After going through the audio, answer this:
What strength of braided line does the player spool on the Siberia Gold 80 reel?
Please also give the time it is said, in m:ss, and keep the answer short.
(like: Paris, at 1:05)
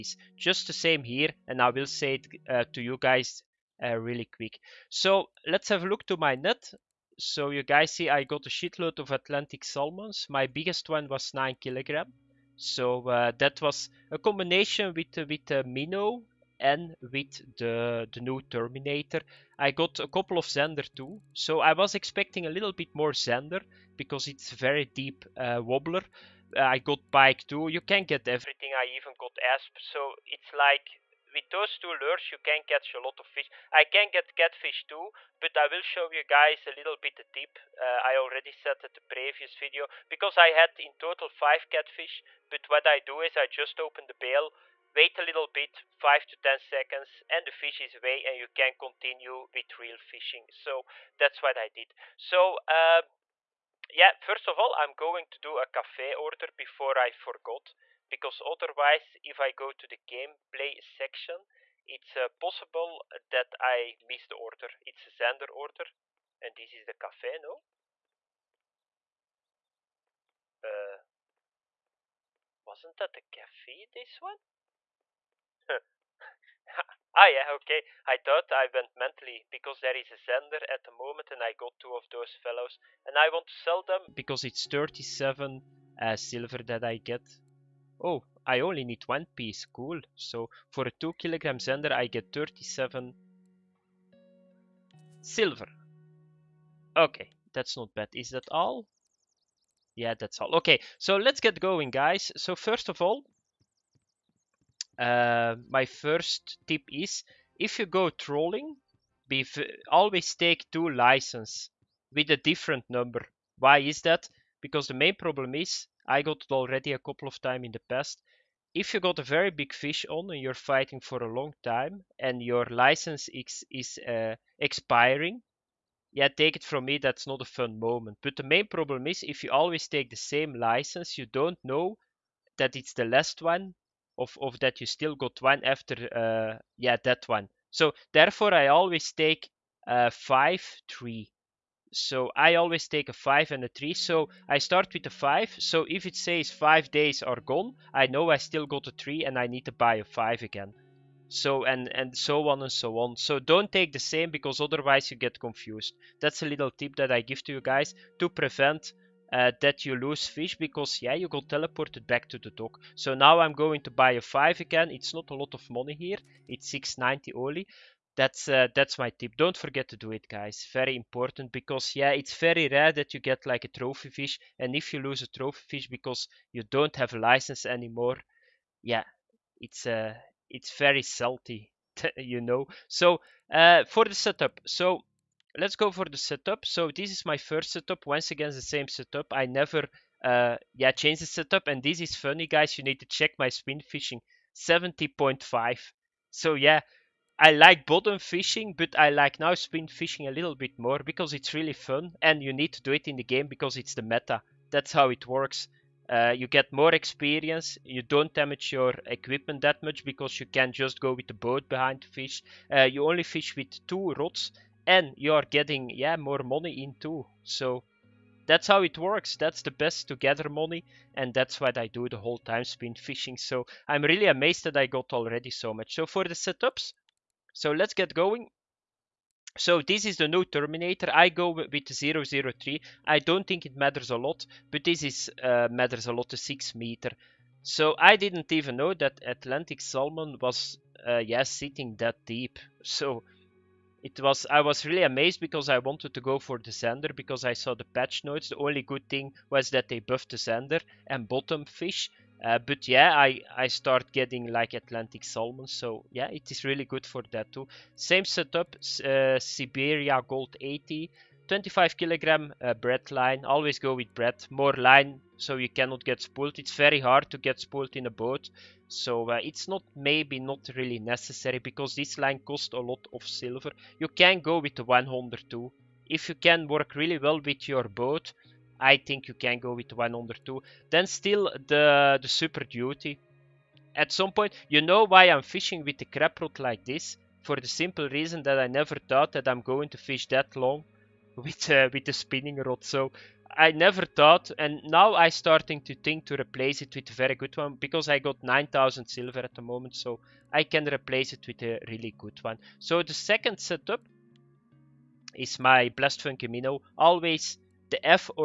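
25 kilograms, at 4:21.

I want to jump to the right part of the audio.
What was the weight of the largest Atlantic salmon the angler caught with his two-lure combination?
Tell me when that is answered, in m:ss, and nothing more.
0:11.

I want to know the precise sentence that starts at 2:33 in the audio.
So don't take the same because otherwise you get confused.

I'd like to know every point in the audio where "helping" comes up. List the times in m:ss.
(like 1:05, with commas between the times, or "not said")
not said.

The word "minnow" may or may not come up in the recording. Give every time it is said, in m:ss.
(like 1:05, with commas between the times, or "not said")
0:15, 5:06.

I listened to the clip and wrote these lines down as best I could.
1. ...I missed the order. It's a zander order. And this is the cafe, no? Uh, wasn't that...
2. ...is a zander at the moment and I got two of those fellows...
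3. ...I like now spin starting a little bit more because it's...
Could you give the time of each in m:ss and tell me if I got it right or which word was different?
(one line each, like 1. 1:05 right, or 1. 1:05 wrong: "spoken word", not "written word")
1. 1:03 right
2. 1:19 right
3. 3:18 wrong: "fishing", not "starting".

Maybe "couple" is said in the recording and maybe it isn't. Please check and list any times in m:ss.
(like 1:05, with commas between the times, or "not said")
0:20, 1:56.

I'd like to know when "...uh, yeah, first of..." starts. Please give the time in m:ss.
0:52.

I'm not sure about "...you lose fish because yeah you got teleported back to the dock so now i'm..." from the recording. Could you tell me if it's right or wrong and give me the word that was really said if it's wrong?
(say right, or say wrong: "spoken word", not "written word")
right.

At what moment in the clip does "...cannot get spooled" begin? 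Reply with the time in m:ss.
4:25.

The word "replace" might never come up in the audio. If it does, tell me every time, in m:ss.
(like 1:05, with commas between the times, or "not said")
4:56, 5:00.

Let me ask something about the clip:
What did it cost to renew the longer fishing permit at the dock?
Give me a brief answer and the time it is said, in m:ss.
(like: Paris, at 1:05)
690, at 2:46.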